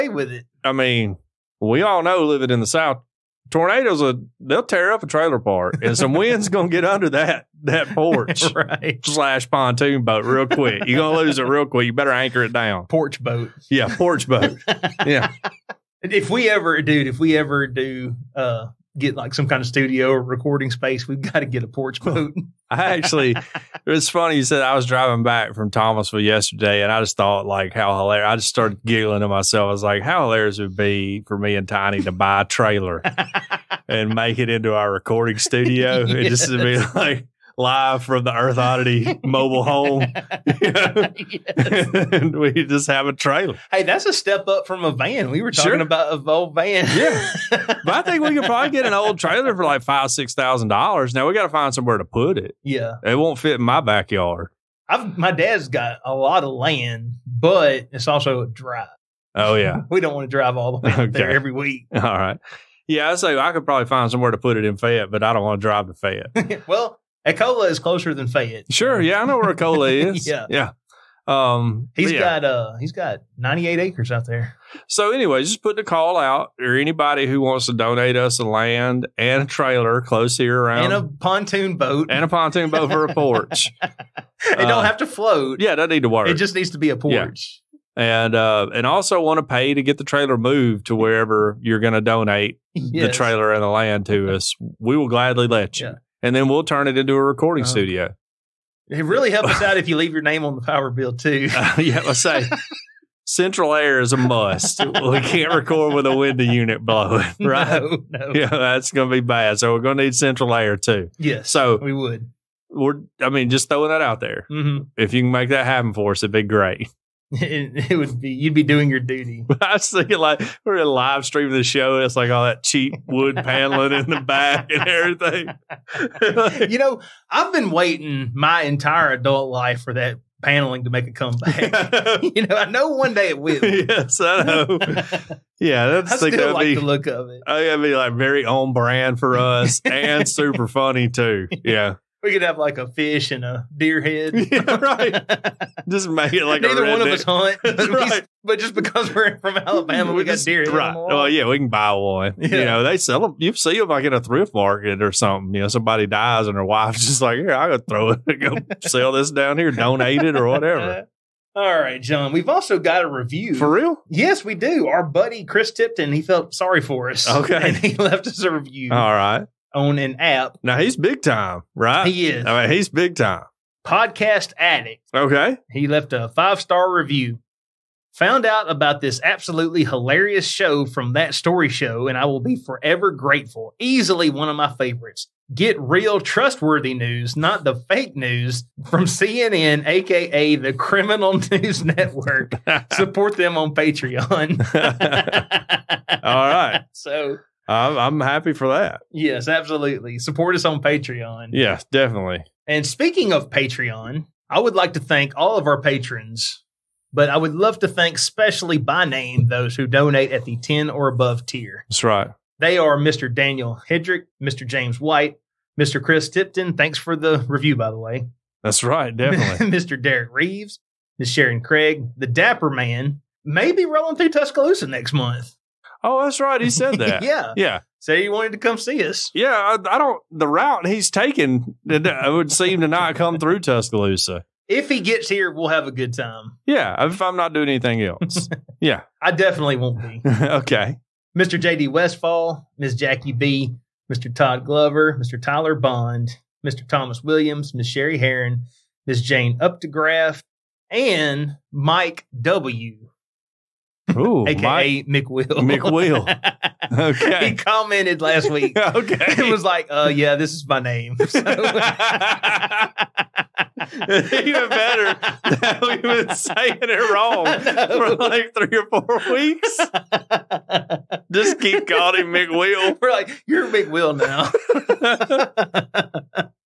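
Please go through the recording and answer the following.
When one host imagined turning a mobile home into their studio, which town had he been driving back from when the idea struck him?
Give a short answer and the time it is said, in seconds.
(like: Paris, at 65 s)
Thomasville, at 25 s.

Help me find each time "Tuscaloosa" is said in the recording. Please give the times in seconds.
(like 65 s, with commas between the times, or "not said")
224 s, 233 s.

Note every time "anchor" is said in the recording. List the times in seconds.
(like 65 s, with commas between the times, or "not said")
12 s.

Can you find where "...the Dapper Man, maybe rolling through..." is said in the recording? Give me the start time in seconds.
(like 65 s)
222 s.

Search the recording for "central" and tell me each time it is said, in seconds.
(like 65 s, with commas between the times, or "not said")
103 s, 110 s.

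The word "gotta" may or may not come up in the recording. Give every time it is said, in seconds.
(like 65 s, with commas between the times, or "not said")
51 s, 157 s.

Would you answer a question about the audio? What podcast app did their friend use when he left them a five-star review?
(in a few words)
Podcast Addict.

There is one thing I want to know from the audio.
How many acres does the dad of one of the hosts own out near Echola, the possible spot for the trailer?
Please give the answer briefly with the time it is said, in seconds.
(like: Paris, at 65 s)
98, at 73 s.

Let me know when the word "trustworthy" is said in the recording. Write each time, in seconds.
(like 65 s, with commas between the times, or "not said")
186 s.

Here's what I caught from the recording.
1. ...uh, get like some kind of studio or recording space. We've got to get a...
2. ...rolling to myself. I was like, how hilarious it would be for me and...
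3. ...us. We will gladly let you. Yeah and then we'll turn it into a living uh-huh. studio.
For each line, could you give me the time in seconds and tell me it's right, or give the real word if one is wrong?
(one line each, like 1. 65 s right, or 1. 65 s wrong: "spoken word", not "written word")
1. 18 s right
2. 28 s wrong: "giggling", not "rolling"
3. 94 s wrong: "recording", not "living".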